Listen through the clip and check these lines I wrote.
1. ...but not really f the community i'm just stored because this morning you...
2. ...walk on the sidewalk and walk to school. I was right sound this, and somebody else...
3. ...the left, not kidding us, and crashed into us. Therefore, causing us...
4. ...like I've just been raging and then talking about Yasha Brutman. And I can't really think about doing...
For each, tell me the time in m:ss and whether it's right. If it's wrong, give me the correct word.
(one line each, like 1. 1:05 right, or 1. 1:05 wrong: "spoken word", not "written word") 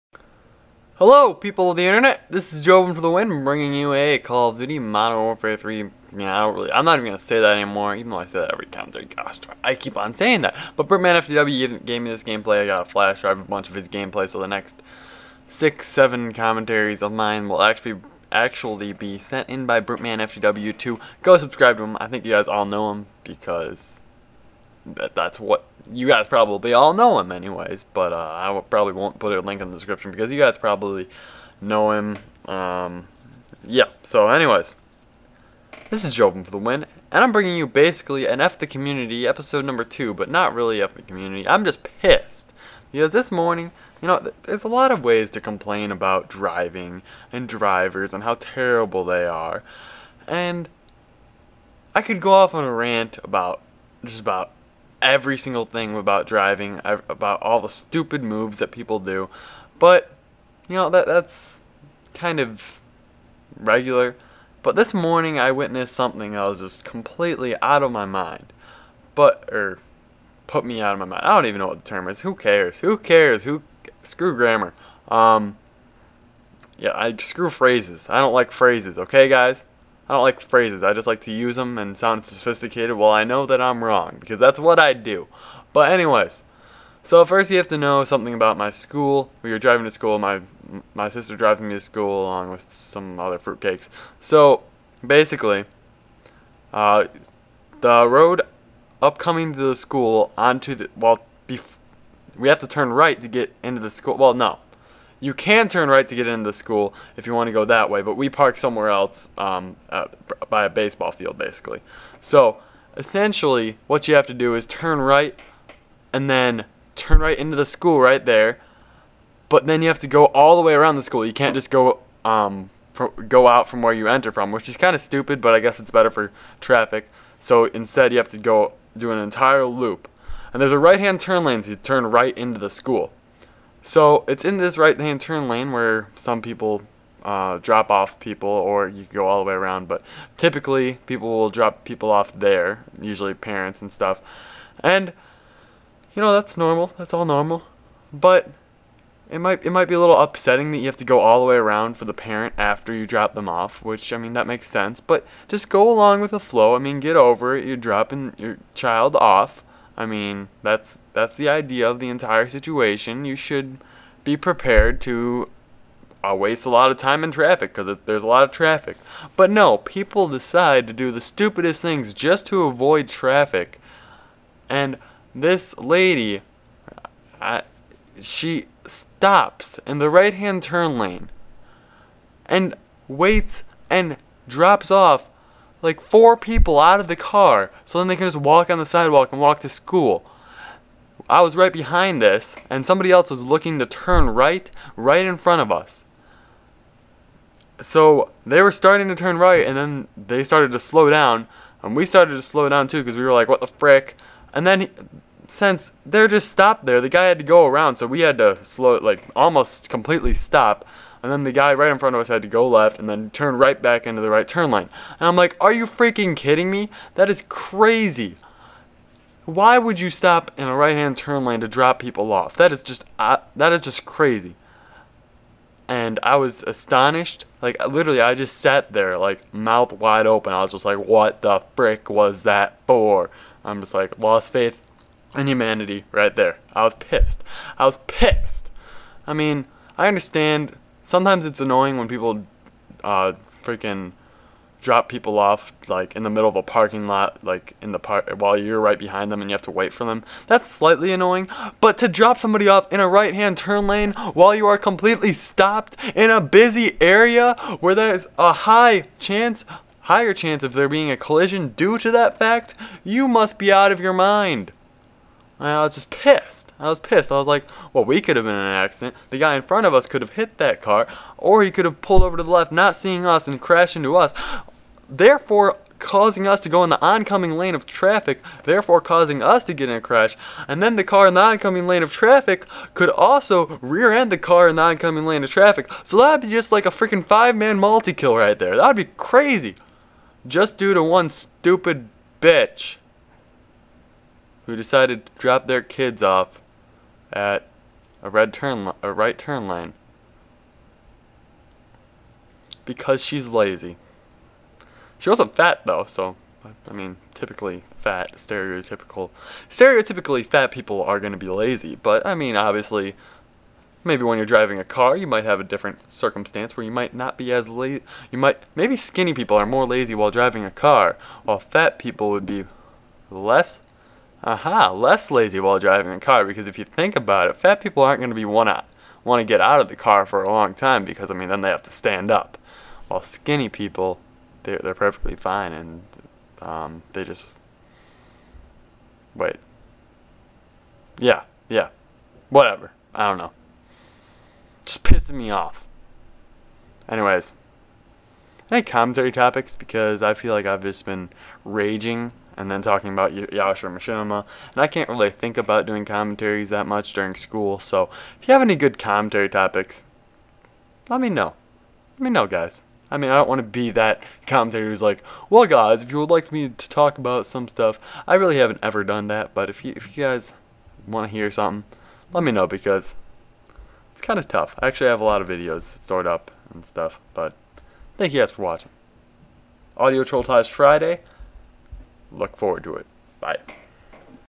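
1. 0:40 wrong: "pissed", not "stored"
2. 3:08 wrong: "behind", not "sound"
3. 4:32 wrong: "seeing", not "kidding"
4. 5:50 wrong: "Machinima", not "Brutman".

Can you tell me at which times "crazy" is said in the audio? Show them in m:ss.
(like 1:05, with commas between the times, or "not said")
3:37, 3:44, 4:49.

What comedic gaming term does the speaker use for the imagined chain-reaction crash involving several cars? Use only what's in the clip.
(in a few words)
Five man multi kill.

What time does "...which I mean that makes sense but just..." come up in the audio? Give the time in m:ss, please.
2:33.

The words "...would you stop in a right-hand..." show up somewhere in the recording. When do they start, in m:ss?
3:39.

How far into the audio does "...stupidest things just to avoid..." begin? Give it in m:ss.
2:51.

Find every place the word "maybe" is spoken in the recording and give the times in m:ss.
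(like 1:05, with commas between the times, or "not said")
5:14, 5:18.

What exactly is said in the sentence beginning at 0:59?
But, you know, that that's kind of regular.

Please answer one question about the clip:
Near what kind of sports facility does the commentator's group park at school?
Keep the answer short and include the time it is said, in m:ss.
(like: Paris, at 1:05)
A baseball field, at 1:50.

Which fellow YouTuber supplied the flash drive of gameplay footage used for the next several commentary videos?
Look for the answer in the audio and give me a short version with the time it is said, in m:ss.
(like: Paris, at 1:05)
Birdman FTW, at 0:10.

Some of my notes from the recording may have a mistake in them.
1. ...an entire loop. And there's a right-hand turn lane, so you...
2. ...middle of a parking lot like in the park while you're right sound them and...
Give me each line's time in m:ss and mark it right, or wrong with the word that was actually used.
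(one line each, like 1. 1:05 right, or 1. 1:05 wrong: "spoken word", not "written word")
1. 2:09 right
2. 4:06 wrong: "behind", not "sound".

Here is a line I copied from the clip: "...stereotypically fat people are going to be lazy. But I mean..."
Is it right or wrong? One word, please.
right.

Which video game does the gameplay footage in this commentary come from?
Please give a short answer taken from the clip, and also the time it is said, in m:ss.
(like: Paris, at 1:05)
Call of Duty Modern Warfare 3, at 0:04.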